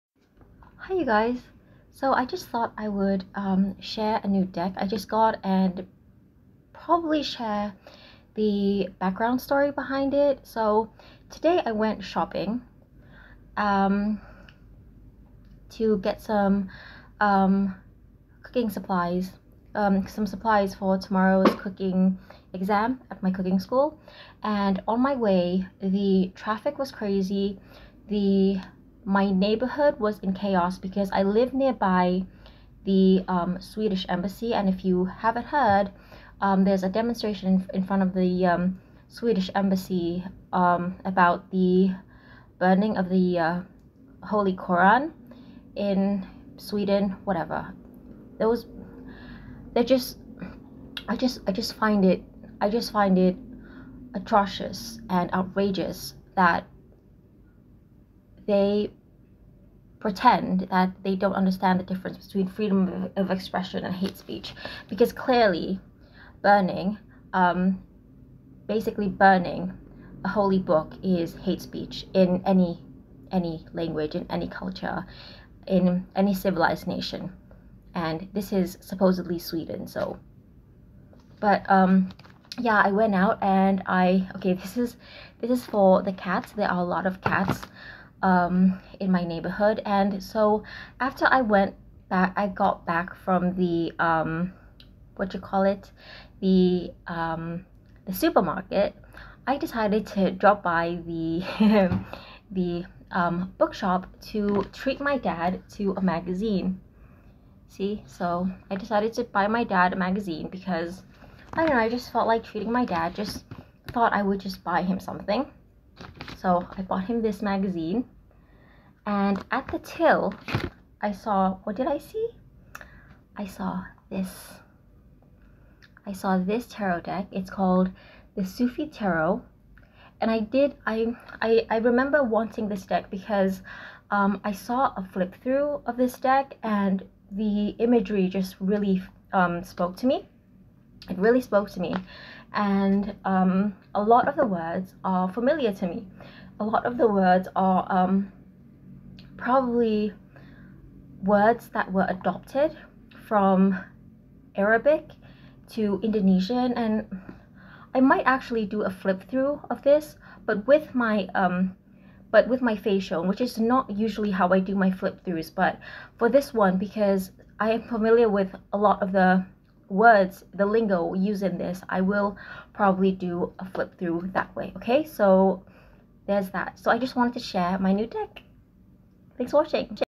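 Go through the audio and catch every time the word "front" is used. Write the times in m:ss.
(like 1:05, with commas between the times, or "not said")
0:37.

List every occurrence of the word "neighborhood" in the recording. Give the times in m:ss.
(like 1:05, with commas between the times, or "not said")
0:29, 1:29.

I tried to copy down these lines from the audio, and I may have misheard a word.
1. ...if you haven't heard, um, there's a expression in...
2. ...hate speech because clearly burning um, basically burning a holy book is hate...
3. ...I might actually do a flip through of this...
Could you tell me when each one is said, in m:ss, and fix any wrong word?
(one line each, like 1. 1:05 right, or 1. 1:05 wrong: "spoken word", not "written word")
1. 0:34 wrong: "demonstration", not "expression"
2. 1:03 right
3. 2:37 right.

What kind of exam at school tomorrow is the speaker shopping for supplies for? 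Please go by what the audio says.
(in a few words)
cooking exam.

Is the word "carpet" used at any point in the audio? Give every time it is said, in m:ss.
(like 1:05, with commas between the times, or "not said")
not said.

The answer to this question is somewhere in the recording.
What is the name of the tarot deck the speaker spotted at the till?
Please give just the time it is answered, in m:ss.
2:08.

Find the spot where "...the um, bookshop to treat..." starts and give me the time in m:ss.
1:42.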